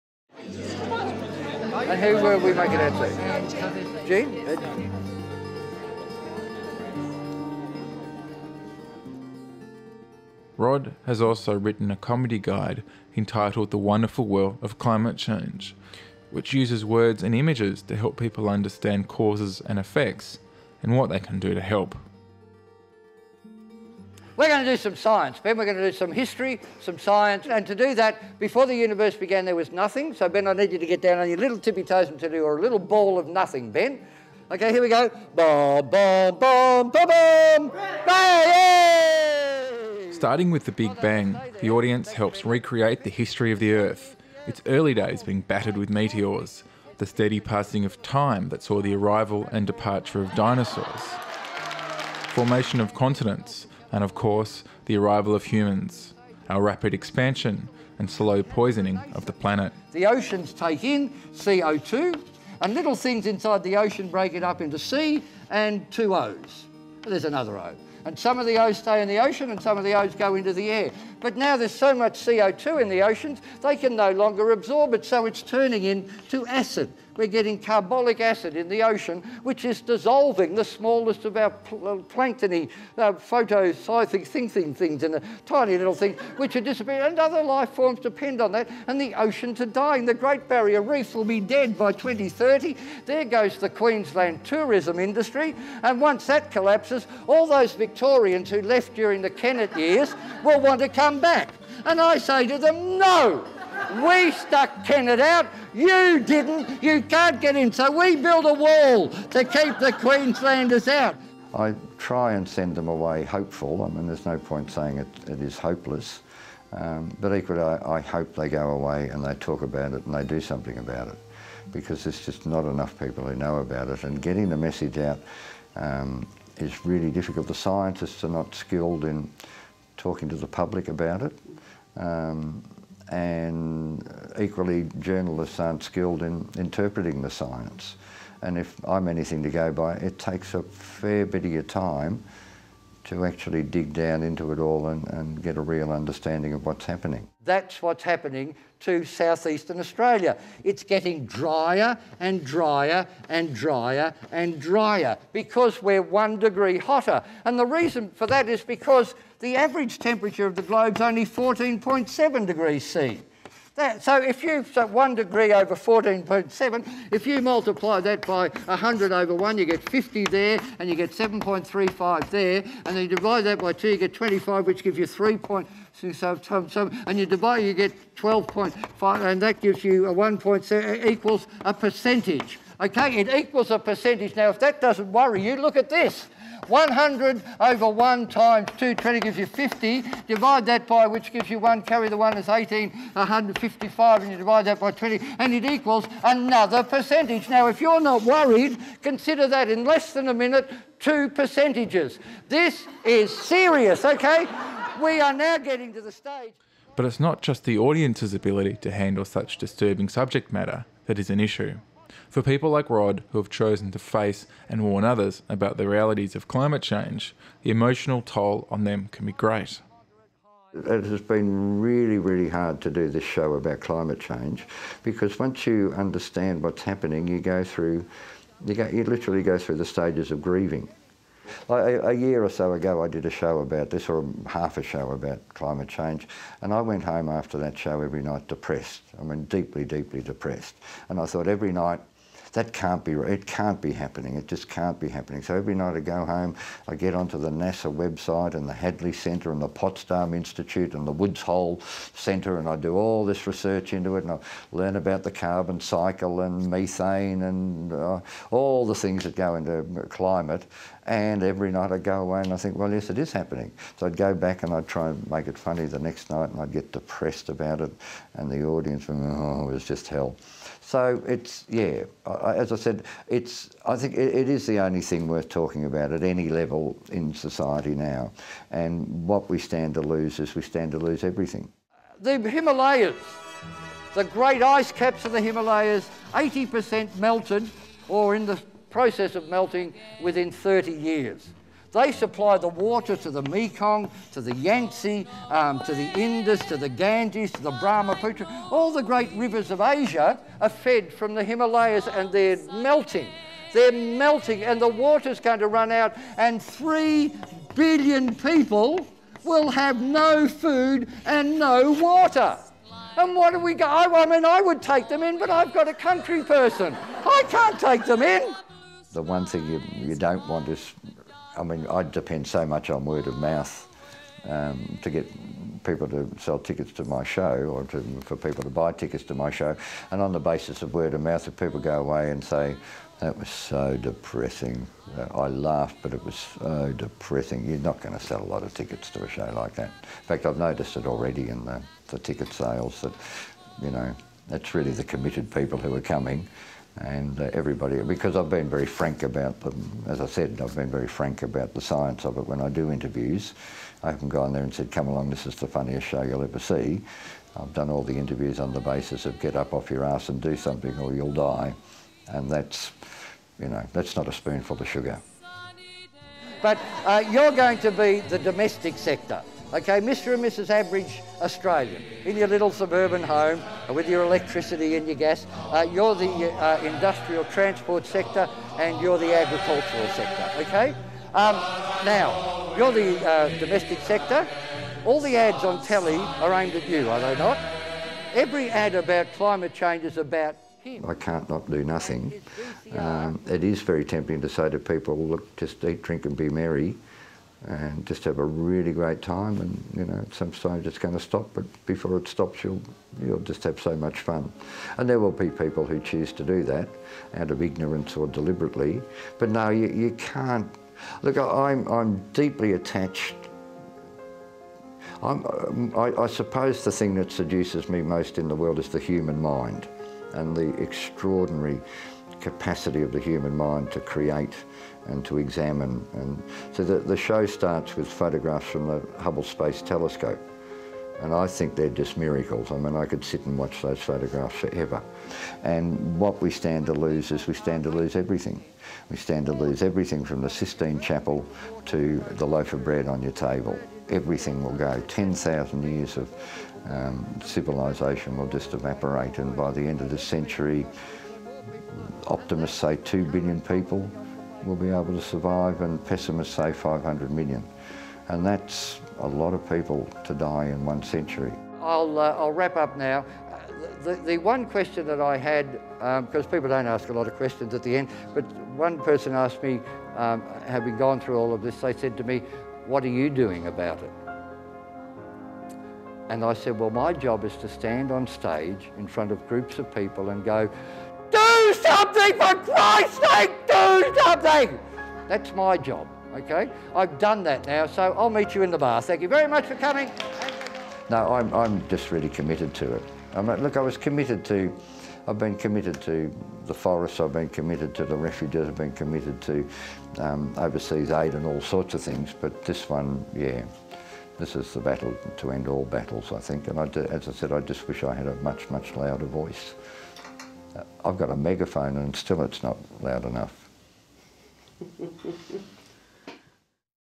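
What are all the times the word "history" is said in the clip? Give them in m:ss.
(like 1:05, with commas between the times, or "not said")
0:26, 0:43.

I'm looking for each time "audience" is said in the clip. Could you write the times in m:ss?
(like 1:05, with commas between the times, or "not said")
0:41, 3:27, 4:28.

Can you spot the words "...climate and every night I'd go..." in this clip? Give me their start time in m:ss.
4:20.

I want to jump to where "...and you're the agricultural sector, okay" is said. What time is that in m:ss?
6:18.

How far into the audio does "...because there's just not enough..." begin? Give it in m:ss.
2:01.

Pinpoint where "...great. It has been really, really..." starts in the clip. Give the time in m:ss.
3:39.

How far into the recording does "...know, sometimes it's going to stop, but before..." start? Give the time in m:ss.
6:40.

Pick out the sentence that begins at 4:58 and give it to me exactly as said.
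All the great rivers of Asia are fed from the Himalayas and they're melting.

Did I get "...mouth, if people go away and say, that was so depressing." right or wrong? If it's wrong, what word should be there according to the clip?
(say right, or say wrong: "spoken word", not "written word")
right.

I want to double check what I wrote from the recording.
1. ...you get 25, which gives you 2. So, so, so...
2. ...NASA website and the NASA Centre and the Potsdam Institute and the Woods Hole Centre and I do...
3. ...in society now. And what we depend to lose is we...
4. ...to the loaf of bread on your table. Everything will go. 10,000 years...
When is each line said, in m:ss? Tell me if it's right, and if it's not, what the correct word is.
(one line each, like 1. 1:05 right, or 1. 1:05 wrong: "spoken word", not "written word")
1. 2:53 wrong: "3", not "2"
2. 4:07 wrong: "Hadley", not "NASA"
3. 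4:37 wrong: "stand", not "depend"
4. 7:21 right.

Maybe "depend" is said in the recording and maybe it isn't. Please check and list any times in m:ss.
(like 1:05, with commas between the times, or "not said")
1:27, 5:22.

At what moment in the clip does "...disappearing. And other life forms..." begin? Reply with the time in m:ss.
1:26.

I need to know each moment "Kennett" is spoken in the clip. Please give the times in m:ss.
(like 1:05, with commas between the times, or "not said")
1:39, 1:44.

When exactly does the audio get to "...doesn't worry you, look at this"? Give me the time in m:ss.
3:04.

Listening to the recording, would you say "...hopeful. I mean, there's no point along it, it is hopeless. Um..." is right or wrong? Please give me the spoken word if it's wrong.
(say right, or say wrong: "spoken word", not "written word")
wrong: "saying", not "along".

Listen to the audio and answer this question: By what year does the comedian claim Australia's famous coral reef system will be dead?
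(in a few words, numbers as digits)
2030.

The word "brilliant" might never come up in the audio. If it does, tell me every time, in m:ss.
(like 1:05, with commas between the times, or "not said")
not said.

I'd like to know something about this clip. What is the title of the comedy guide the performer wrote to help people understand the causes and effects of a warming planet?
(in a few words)
The Wonderful World of Climate Change.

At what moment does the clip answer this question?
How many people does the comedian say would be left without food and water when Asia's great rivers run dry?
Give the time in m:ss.
5:06.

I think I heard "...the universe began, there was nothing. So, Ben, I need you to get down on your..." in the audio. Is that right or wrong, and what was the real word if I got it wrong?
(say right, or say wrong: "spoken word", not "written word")
right.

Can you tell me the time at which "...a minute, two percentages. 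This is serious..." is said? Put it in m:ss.
3:20.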